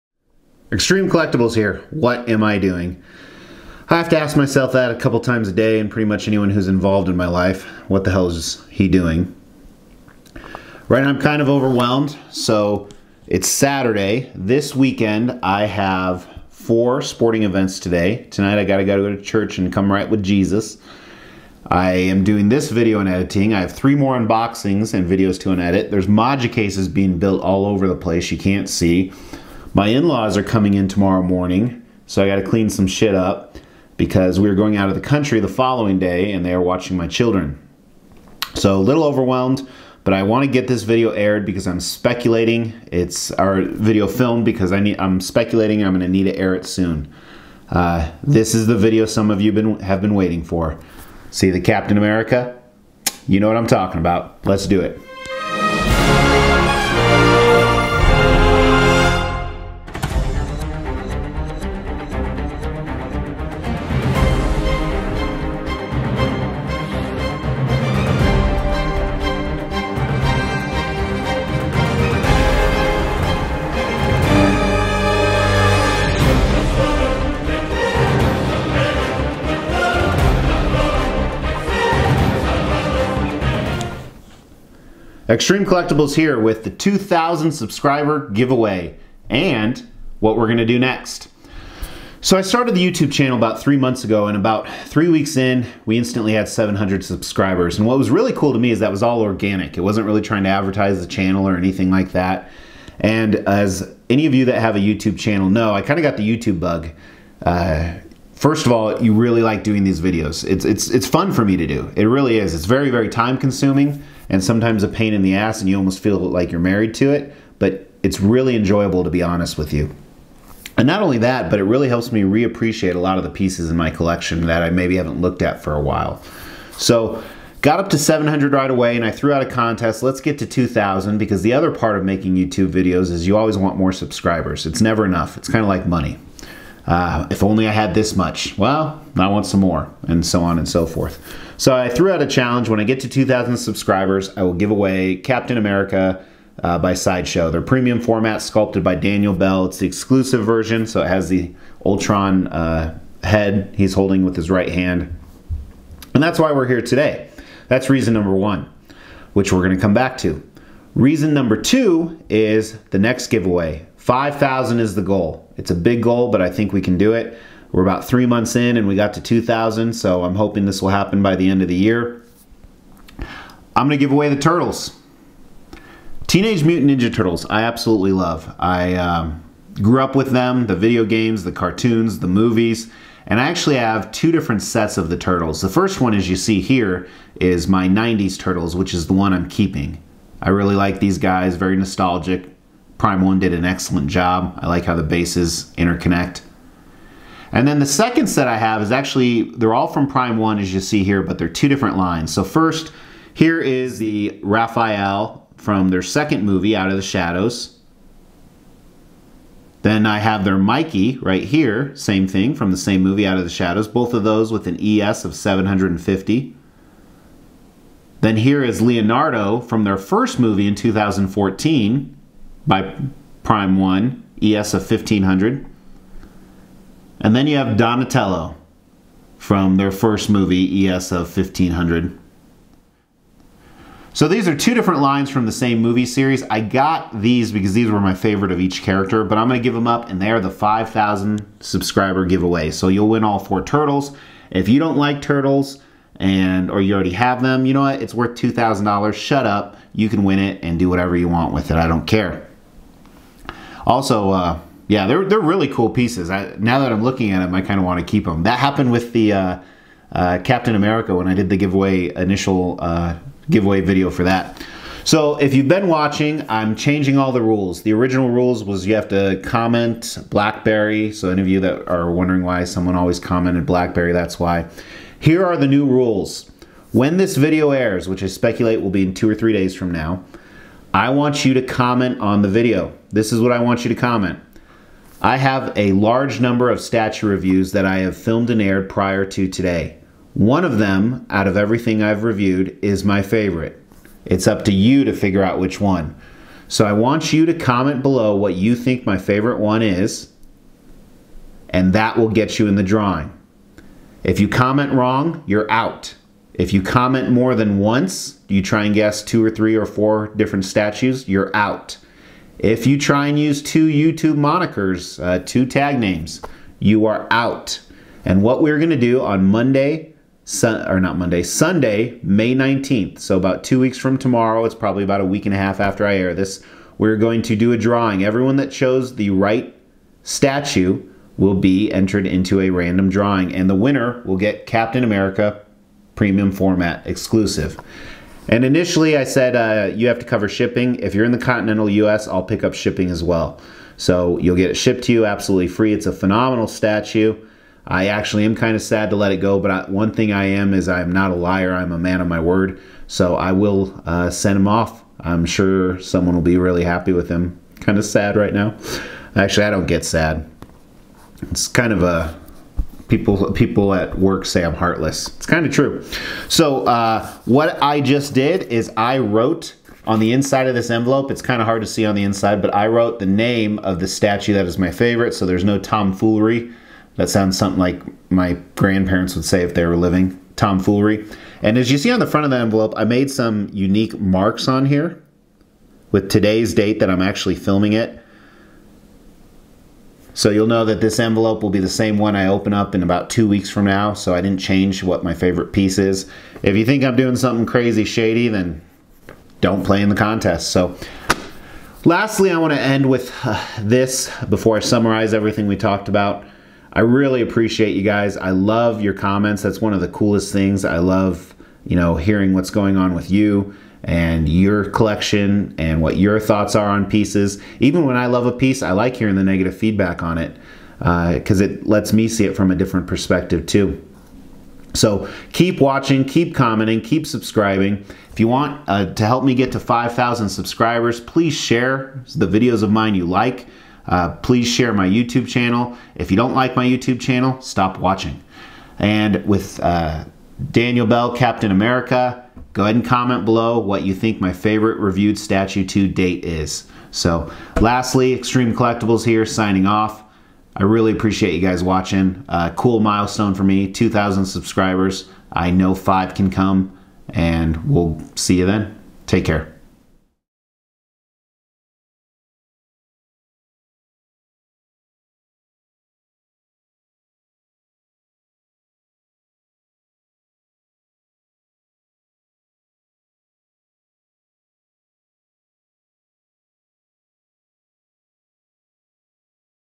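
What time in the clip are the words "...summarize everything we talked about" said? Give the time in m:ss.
6:44.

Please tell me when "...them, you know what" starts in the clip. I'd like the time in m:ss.
4:07.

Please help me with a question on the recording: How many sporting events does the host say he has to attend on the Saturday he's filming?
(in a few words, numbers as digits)
4.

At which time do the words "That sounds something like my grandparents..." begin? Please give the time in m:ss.
6:17.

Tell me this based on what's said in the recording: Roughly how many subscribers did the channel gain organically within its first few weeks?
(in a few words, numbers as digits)
700.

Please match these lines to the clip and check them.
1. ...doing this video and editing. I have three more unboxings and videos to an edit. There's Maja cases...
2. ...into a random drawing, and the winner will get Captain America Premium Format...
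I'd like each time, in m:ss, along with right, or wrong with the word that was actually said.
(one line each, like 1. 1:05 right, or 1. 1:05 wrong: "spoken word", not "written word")
1. 0:22 right
2. 5:32 right.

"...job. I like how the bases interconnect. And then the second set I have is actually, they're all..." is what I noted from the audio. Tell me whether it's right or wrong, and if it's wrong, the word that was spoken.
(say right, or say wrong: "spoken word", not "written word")
right.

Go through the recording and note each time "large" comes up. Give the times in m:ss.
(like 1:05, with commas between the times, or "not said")
4:45.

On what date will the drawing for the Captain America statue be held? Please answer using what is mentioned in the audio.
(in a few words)
Sunday, May 19th.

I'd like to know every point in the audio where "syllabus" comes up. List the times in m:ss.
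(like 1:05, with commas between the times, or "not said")
not said.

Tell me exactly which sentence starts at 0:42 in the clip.
It's our video filmed because I need, I'm speculating I'm going to need to air it soon.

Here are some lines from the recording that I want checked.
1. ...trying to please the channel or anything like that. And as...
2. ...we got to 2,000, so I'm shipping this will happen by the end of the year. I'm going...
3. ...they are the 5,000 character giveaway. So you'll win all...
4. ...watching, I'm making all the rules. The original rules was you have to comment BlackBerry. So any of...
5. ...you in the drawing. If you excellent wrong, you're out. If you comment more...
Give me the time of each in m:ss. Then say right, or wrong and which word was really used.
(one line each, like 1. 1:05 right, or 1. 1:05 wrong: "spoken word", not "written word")
1. 1:40 wrong: "advertise", not "please"
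2. 2:48 wrong: "hoping", not "shipping"
3. 4:00 wrong: "subscriber", not "character"
4. 4:25 wrong: "changing", not "making"
5. 5:02 wrong: "comment", not "excellent".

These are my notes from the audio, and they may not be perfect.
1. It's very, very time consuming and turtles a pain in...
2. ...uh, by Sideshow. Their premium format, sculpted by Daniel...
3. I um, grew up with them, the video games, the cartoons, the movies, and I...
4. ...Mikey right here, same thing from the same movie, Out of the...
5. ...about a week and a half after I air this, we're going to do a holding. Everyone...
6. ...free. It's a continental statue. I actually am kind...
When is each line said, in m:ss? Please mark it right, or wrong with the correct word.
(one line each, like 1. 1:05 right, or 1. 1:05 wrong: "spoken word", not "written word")
1. 1:52 wrong: "sometimes", not "turtles"
2. 2:26 right
3. 2:58 right
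4. 3:30 right
5. 5:25 wrong: "drawing", not "holding"
6. 5:45 wrong: "phenomenal", not "continental".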